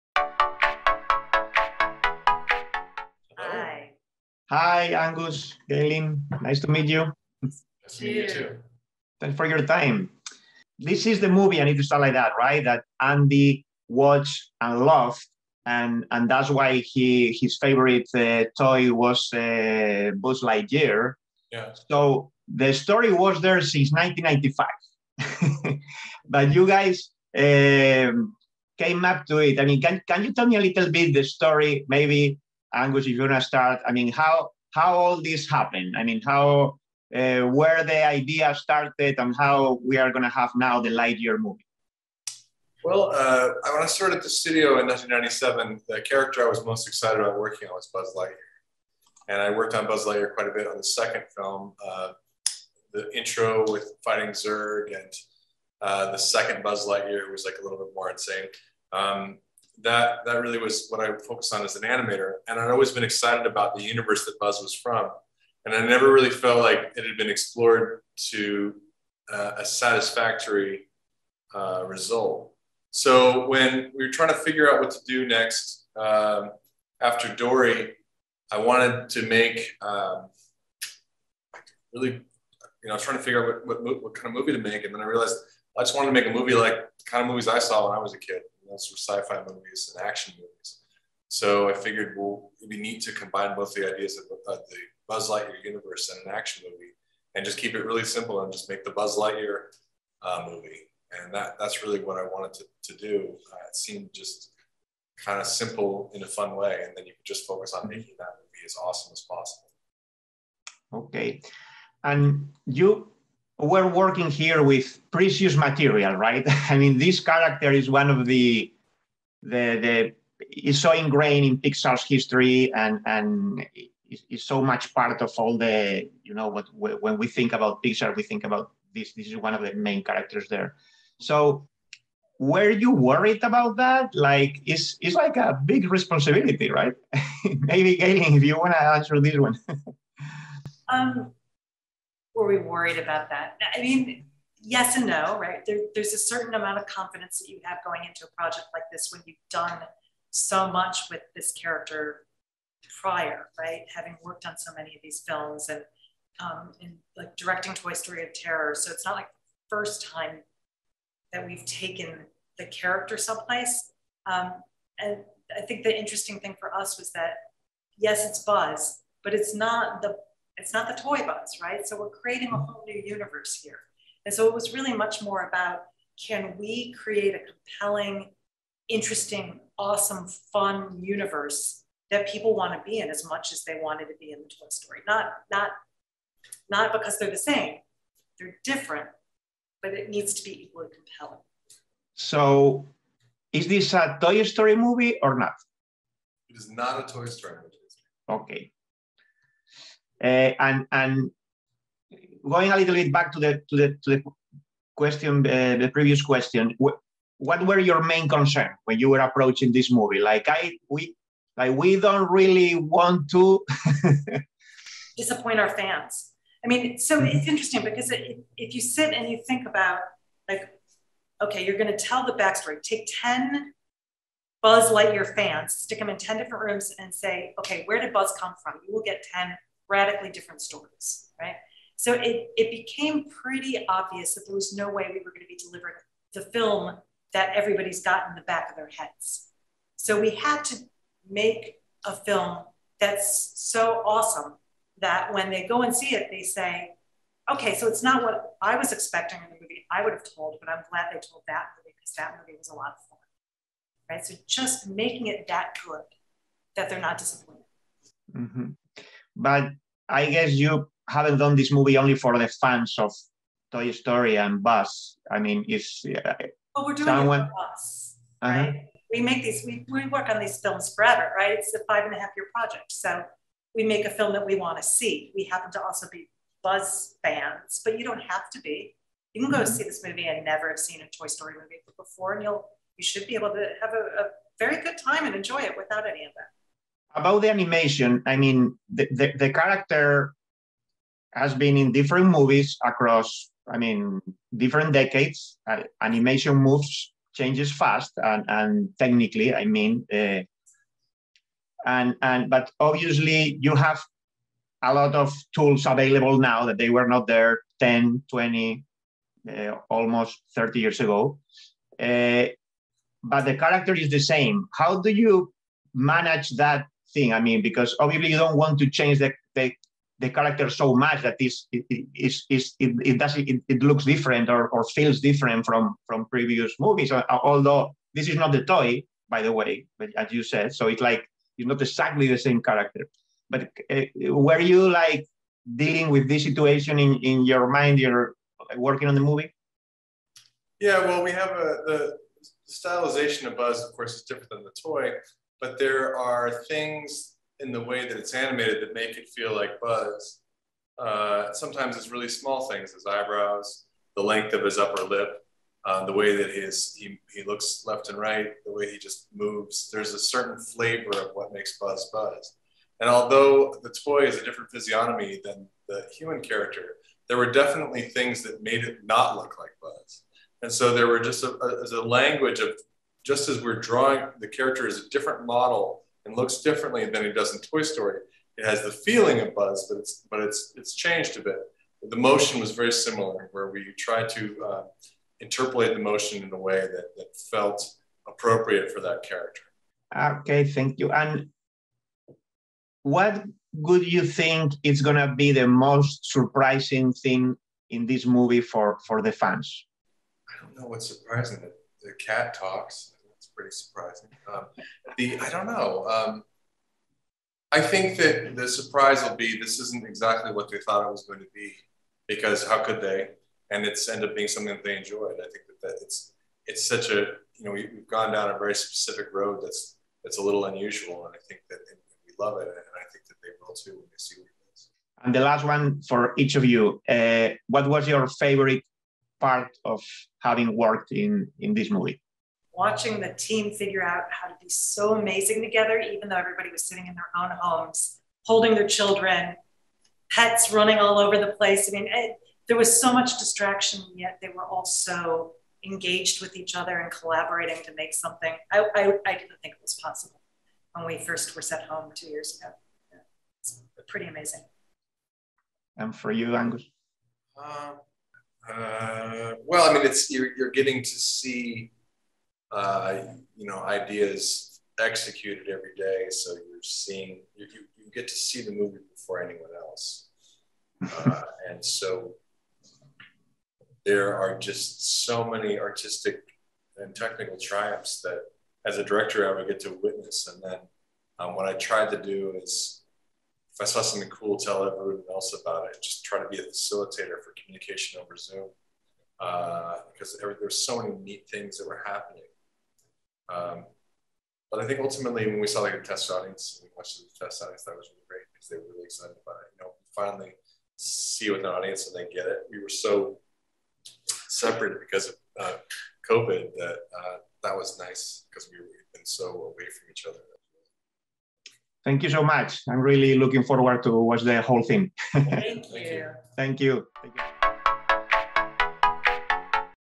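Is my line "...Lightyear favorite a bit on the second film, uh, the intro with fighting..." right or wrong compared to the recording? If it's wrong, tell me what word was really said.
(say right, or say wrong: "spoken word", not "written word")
wrong: "quite", not "favorite".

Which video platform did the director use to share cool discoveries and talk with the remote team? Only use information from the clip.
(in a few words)
Zoom.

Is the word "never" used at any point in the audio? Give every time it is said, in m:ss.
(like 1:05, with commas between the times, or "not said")
1:05, 4:40.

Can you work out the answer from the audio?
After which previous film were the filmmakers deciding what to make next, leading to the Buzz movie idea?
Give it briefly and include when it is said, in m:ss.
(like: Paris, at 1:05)
Dory, at 1:17.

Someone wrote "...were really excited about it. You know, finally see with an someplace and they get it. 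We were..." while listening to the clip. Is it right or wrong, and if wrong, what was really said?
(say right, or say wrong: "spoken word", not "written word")
wrong: "audience", not "someplace".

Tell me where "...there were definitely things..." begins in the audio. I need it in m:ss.
6:07.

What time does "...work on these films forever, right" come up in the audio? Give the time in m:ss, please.
4:30.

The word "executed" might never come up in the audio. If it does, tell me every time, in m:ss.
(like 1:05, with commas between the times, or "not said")
7:44.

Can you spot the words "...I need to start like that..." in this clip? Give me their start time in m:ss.
0:11.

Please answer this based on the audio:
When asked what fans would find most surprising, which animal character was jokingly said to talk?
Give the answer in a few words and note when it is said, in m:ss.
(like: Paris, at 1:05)
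The cat, at 6:42.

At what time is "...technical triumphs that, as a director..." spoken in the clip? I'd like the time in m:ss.
7:57.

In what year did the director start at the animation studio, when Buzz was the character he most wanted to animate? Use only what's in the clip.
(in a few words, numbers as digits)
1997.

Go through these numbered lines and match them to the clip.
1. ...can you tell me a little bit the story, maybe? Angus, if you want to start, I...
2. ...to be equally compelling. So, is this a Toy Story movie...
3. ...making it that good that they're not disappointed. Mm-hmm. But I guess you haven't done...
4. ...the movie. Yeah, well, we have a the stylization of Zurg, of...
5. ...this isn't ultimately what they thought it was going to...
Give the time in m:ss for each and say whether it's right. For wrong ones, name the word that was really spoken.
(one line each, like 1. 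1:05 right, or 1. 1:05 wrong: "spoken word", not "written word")
1. 0:30 right
2. 3:10 right
3. 4:14 right
4. 5:39 wrong: "Buzz", not "Zurg"
5. 6:49 wrong: "exactly", not "ultimately".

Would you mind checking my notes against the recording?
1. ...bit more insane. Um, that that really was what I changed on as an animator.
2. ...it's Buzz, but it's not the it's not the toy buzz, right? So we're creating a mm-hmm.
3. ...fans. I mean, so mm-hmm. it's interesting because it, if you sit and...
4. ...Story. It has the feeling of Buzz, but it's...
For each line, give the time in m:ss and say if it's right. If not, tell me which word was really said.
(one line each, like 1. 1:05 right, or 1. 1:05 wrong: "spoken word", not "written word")
1. 0:57 wrong: "focused", not "changed"
2. 2:48 right
3. 3:35 right
4. 6:17 right.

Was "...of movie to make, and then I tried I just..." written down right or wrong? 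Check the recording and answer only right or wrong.
wrong.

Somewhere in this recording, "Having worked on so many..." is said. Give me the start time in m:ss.
2:33.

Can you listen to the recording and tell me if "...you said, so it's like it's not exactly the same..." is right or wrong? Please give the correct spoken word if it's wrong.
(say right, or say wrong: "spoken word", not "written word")
right.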